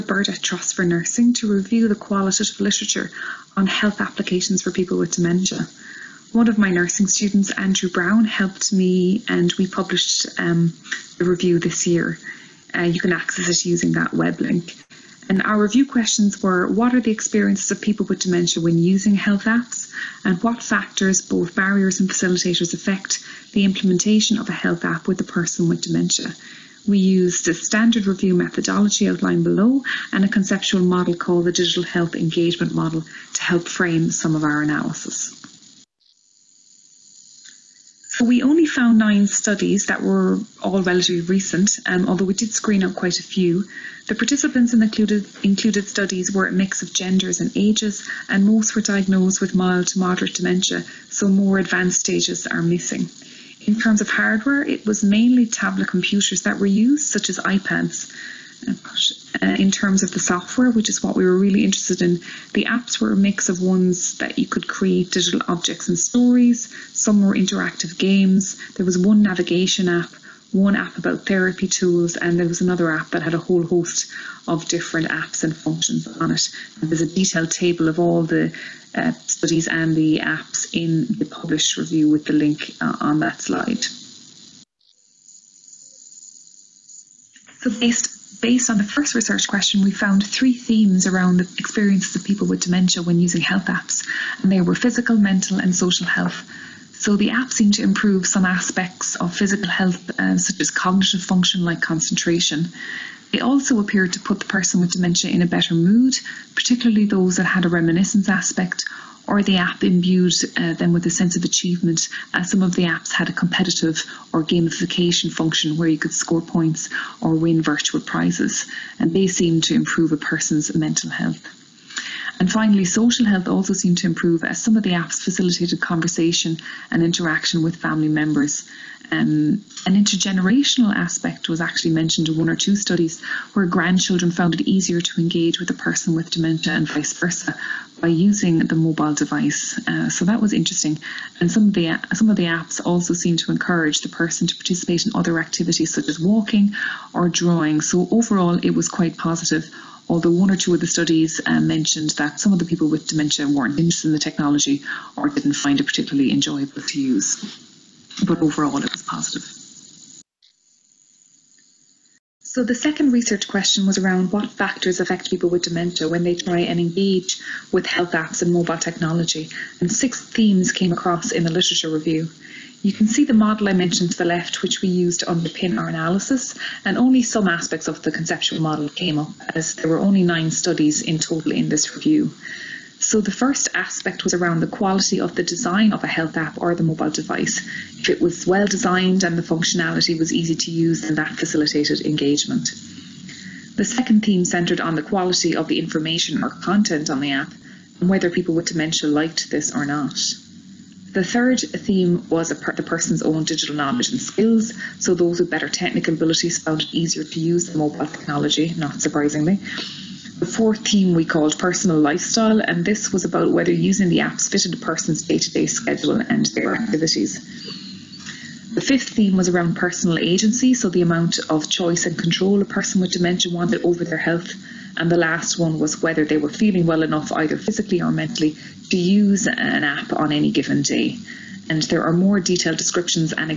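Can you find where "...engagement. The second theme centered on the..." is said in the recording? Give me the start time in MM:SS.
03:12.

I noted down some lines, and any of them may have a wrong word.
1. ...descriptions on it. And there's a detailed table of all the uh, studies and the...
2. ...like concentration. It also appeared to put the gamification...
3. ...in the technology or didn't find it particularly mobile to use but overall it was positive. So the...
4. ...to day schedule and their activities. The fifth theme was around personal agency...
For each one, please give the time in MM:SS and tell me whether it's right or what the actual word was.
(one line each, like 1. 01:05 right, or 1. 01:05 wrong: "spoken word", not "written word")
1. 01:15 wrong: "functions", not "descriptions"
2. 01:41 wrong: "person", not "gamification"
3. 02:34 wrong: "enjoyable", not "mobile"
4. 03:35 right.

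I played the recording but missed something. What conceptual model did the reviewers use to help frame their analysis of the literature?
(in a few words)
Digital Health Engagement Model.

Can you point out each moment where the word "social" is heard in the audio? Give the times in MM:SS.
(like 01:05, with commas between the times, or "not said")
01:35, 02:02.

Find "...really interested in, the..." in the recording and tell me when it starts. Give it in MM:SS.
01:01.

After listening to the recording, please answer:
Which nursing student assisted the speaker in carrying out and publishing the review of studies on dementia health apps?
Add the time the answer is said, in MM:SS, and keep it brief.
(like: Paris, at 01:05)
Andrew Brown, at 00:07.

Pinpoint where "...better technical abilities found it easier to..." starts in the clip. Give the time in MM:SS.
03:25.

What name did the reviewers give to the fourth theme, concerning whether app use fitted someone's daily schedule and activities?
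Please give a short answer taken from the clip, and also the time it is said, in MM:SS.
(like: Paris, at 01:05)
personal lifestyle, at 03:31.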